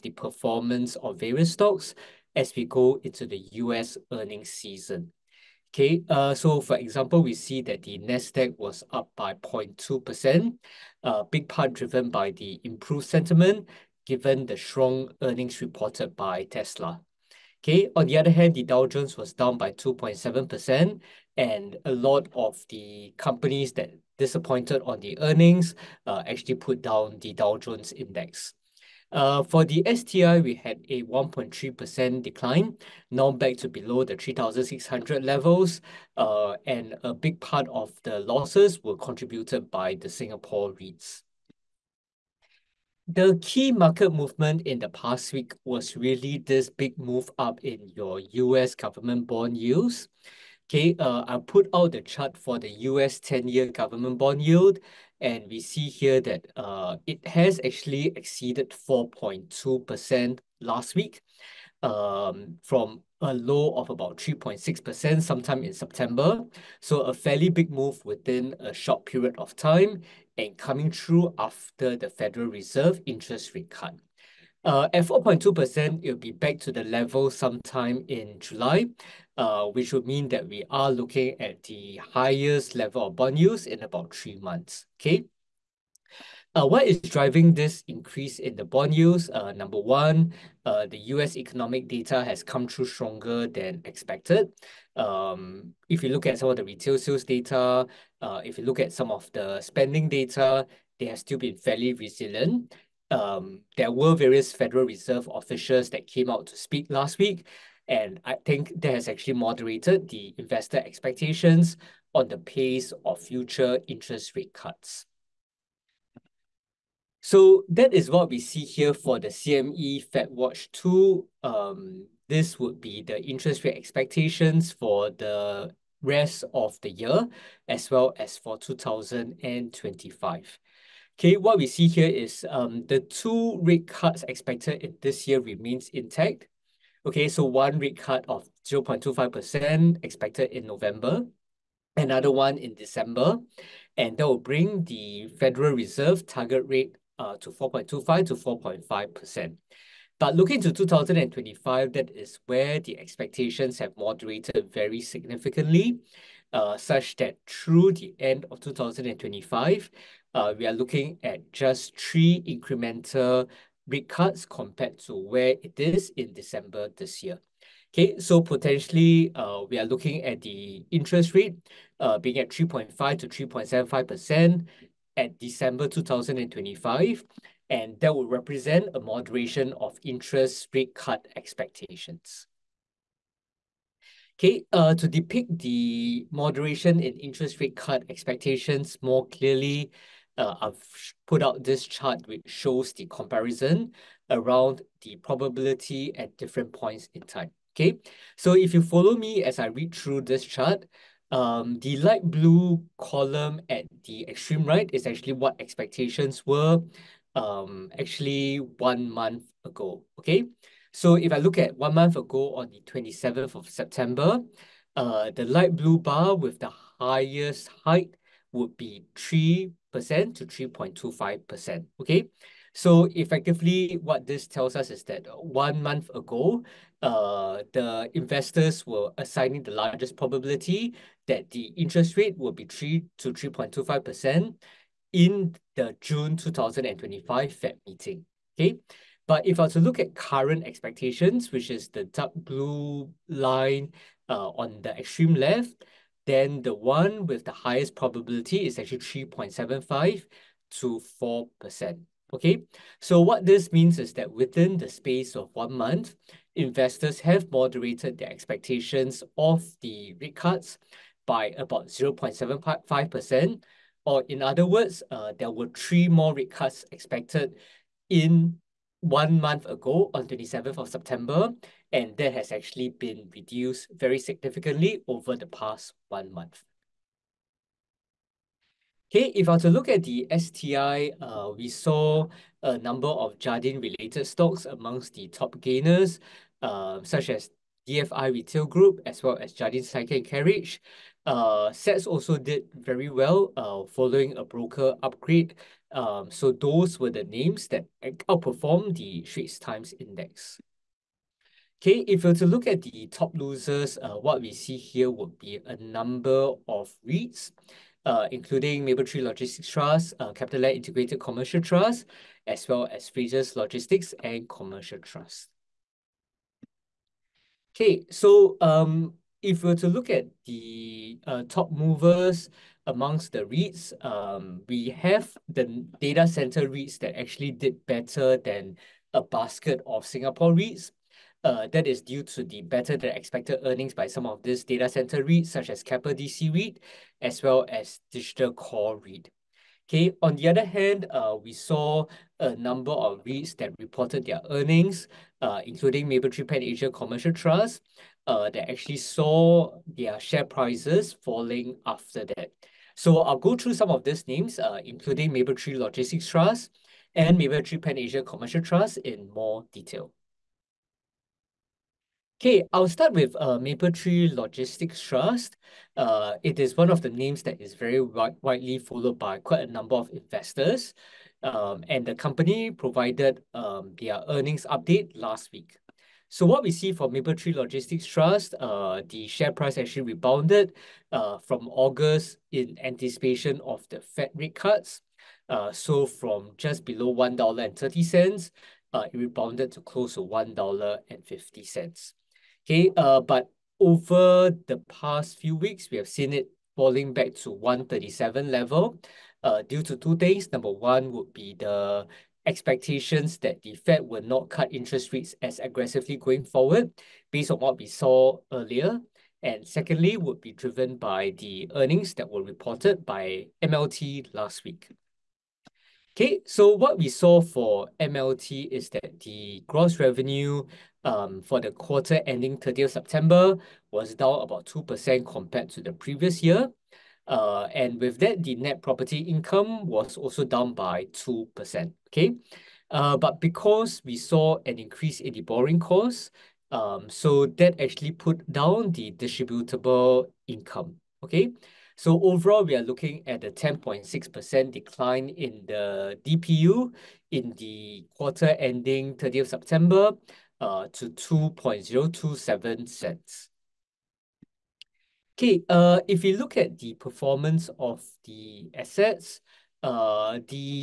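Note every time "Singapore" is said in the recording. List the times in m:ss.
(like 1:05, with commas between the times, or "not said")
0:40, 5:30.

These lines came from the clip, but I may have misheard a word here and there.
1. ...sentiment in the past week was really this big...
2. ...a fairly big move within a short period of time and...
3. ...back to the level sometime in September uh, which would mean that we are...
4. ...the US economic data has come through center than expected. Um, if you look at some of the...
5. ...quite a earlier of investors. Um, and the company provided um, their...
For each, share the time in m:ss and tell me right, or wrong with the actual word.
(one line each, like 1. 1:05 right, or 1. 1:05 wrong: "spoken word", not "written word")
1. 0:44 wrong: "movement", not "sentiment"
2. 1:07 right
3. 1:16 wrong: "July", not "September"
4. 1:30 wrong: "stronger", not "center"
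5. 6:09 wrong: "number", not "earlier".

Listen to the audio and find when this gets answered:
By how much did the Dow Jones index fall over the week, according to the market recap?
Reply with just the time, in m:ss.
0:19.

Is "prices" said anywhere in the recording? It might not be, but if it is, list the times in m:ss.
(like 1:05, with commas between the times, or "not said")
5:50, 6:19.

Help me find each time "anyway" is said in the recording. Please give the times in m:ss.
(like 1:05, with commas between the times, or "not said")
not said.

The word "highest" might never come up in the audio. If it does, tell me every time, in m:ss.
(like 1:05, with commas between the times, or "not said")
1:22, 3:36, 4:07.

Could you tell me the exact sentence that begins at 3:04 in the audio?
Okay, uh, to depict the moderation in interest rate cut expectations more clearly, uh, mm-hmm.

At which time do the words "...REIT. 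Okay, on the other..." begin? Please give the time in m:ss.
5:38.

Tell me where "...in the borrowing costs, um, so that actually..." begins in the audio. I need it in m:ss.
7:15.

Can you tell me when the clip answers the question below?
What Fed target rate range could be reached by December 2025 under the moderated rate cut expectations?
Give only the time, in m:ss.
2:52.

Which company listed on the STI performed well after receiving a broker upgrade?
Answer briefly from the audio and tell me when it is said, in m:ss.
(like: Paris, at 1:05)
SATS, at 4:51.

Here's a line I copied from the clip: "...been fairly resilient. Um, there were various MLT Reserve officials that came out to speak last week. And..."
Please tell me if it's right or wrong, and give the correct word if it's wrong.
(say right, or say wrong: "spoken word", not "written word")
wrong: "Federal", not "MLT".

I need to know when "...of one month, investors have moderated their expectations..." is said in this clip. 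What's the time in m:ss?
4:15.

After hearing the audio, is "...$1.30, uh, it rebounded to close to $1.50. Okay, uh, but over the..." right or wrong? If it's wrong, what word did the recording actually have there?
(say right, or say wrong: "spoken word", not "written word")
right.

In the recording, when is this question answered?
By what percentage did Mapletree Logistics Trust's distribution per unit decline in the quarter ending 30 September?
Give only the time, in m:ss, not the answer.
7:23.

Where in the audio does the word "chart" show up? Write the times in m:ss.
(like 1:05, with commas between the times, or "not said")
0:52, 3:11, 3:20.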